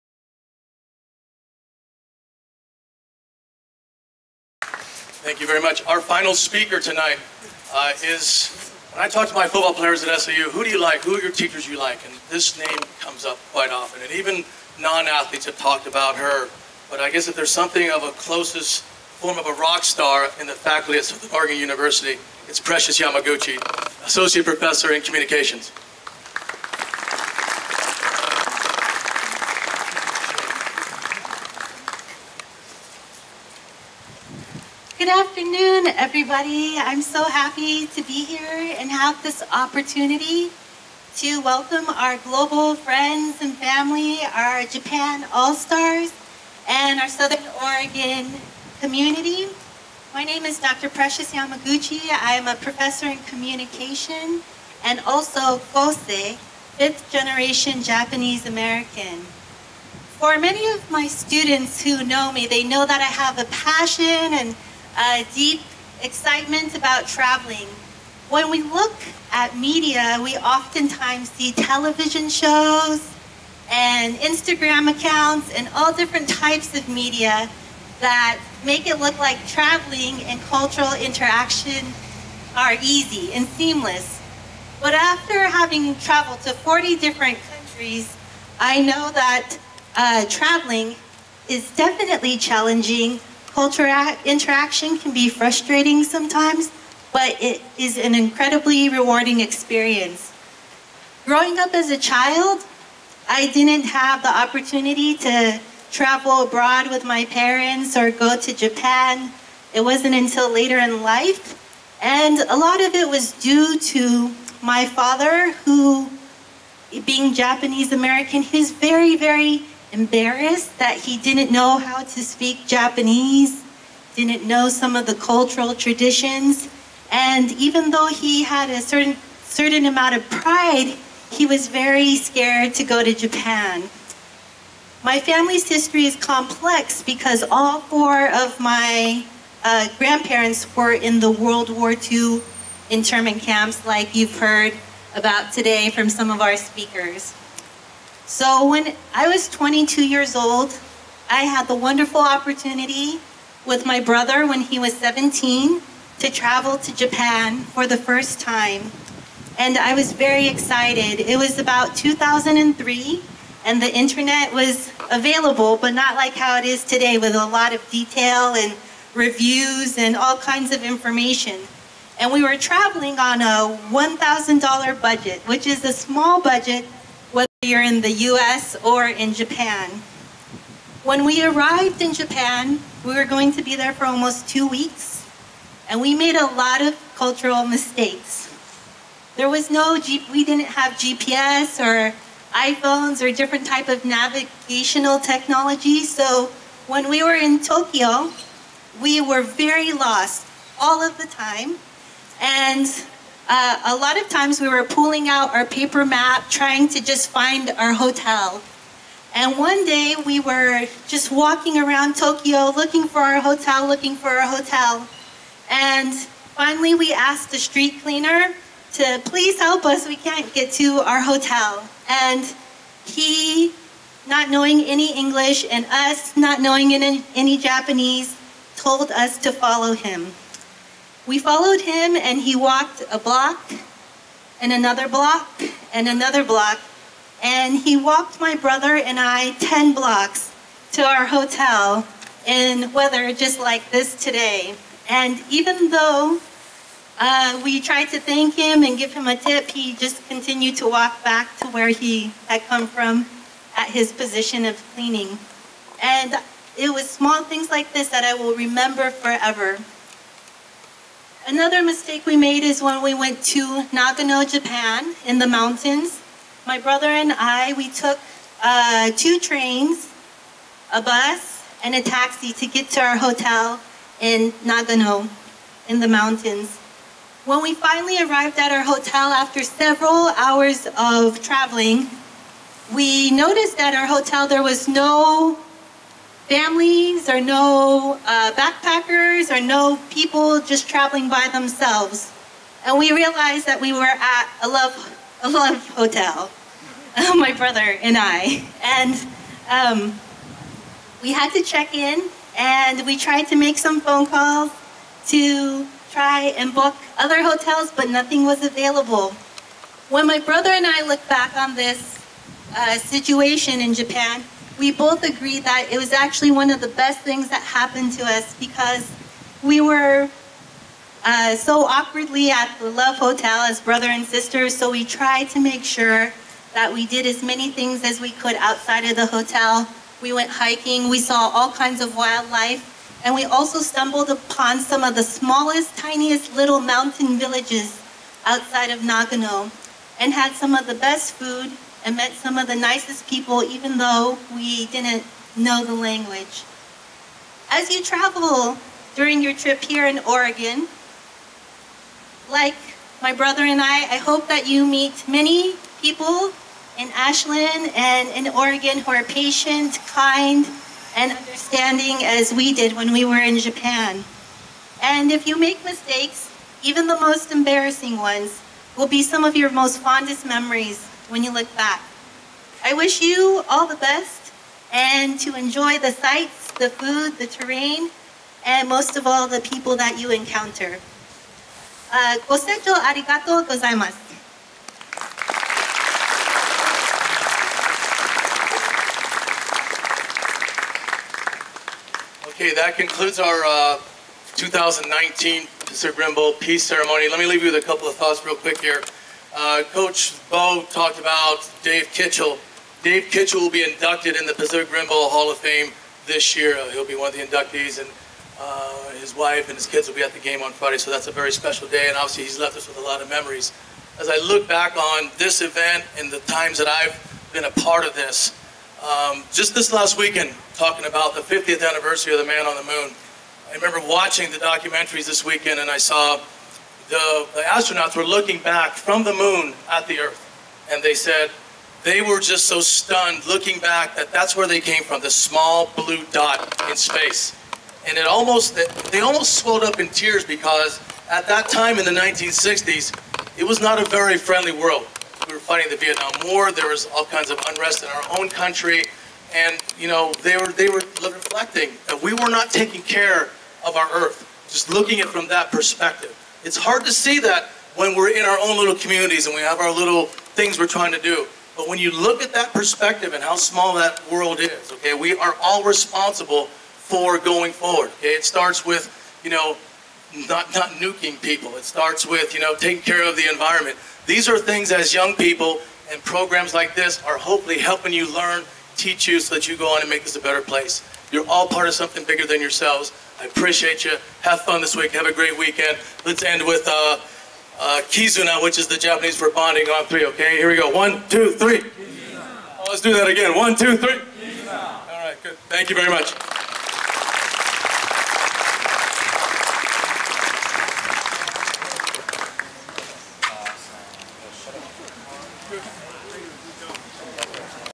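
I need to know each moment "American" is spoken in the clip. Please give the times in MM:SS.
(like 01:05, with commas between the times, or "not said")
00:58, 01:57.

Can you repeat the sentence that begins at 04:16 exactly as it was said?
And it was small things like this that I will remember forever.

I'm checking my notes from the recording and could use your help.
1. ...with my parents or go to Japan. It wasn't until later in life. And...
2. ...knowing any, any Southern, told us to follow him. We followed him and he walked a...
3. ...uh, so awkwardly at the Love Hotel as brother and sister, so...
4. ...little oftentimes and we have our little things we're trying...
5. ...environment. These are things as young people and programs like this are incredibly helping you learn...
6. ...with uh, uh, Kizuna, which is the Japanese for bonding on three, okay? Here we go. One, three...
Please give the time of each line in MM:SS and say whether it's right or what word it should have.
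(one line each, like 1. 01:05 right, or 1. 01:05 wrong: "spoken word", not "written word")
1. 01:46 right
2. 03:46 wrong: "Japanese", not "Southern"
3. 05:21 right
4. 07:38 wrong: "communities", not "oftentimes"
5. 07:53 wrong: "hopefully", not "incredibly"
6. 08:06 wrong: "two", not "three".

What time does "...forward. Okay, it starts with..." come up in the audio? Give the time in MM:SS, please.
07:47.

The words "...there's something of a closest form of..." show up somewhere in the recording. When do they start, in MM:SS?
00:17.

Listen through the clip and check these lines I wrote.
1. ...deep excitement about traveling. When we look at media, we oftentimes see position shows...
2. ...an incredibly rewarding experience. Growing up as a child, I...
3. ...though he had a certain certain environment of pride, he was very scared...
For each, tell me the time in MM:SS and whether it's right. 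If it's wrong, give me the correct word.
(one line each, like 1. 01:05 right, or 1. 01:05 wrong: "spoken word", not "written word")
1. 01:05 wrong: "television", not "position"
2. 01:37 right
3. 02:07 wrong: "amount", not "environment".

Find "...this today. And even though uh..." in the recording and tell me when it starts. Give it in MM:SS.
04:03.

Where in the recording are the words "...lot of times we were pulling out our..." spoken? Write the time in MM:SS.
03:23.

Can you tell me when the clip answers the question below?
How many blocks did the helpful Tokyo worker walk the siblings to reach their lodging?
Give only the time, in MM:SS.
03:59.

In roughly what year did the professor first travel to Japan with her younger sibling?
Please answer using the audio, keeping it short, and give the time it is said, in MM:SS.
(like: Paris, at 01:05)
2003, at 02:41.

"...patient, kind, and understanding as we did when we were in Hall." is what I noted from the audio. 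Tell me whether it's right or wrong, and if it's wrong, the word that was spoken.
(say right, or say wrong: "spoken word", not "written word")
wrong: "Japan", not "Hall".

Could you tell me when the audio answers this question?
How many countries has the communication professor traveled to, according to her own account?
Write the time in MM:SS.
01:26.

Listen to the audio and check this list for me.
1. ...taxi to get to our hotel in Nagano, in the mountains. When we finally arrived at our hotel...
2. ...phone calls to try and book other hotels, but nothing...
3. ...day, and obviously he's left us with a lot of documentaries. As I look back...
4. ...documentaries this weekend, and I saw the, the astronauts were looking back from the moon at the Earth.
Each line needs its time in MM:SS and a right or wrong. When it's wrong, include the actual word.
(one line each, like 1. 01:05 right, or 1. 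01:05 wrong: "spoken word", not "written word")
1. 04:32 right
2. 05:04 right
3. 06:51 wrong: "memories", not "documentaries"
4. 07:04 right.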